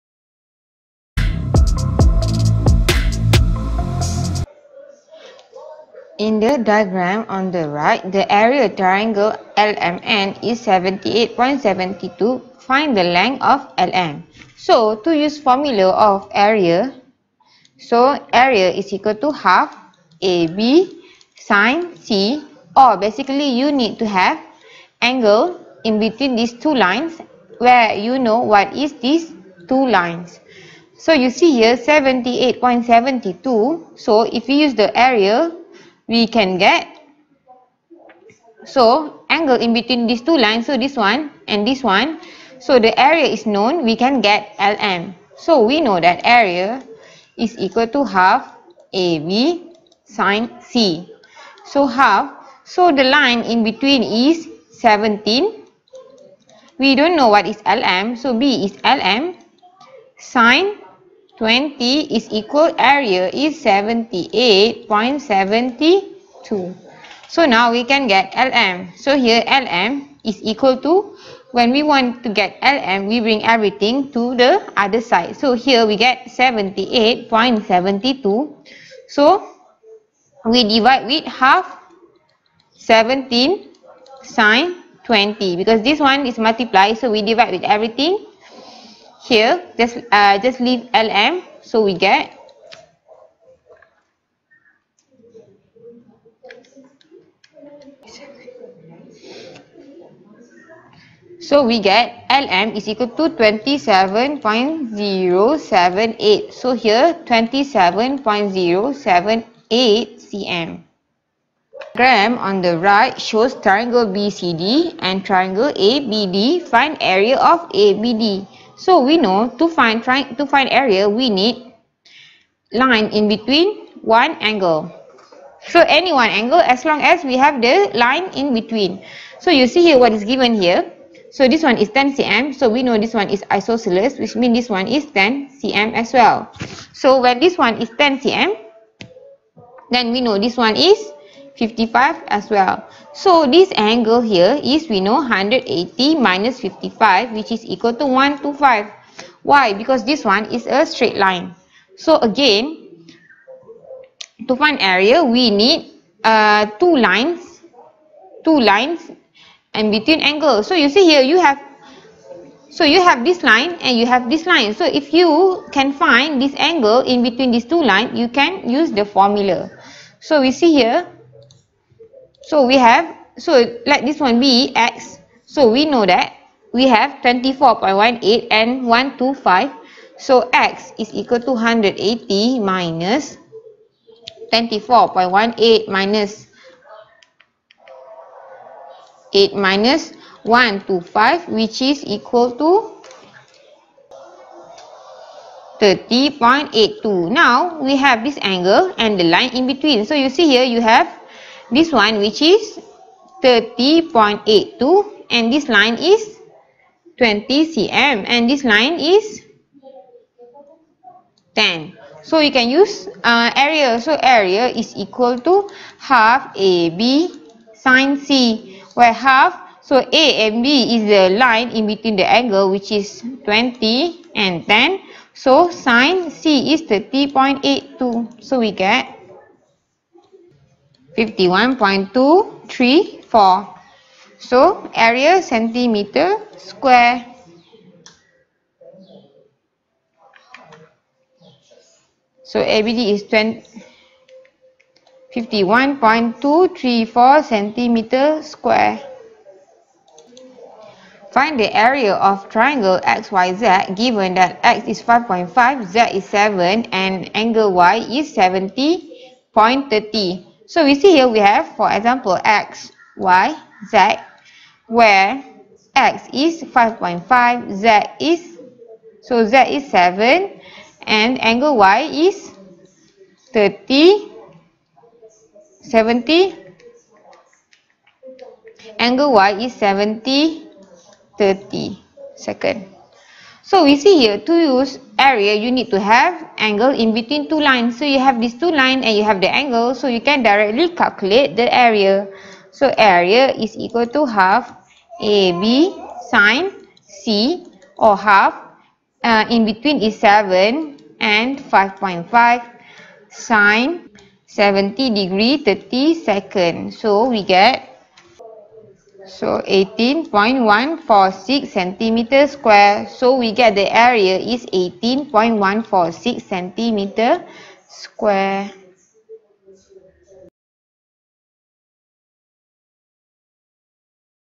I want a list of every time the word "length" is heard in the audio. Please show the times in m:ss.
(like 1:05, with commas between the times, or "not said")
0:13.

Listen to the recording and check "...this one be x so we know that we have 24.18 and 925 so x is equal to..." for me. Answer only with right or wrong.
wrong.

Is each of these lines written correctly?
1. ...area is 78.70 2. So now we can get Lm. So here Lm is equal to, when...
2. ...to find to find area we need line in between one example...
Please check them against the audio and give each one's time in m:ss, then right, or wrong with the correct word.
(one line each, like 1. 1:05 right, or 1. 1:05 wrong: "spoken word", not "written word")
1. 1:02 right
2. 1:59 wrong: "angle", not "example".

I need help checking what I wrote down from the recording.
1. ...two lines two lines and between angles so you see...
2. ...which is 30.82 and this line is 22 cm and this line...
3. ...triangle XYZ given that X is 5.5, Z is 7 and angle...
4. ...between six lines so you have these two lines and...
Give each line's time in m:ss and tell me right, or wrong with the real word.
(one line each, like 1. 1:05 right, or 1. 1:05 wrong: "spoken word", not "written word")
1. 2:36 right
2. 3:22 wrong: "20", not "22"
3. 4:12 right
4. 4:47 wrong: "two", not "six".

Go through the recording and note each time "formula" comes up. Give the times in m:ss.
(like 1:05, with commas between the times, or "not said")
0:15, 2:49.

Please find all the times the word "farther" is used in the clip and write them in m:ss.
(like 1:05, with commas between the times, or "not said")
not said.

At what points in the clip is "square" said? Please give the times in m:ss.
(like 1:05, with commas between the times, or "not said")
3:56, 4:08, 5:12, 5:17.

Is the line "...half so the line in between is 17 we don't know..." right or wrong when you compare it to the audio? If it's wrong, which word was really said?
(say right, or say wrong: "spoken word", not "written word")
right.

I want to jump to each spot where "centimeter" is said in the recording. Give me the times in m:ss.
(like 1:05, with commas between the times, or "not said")
3:55, 4:07, 5:11, 5:16.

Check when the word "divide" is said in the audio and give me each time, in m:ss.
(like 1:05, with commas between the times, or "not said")
1:20, 1:27.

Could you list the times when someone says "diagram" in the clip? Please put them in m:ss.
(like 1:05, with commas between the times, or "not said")
0:06, 1:51.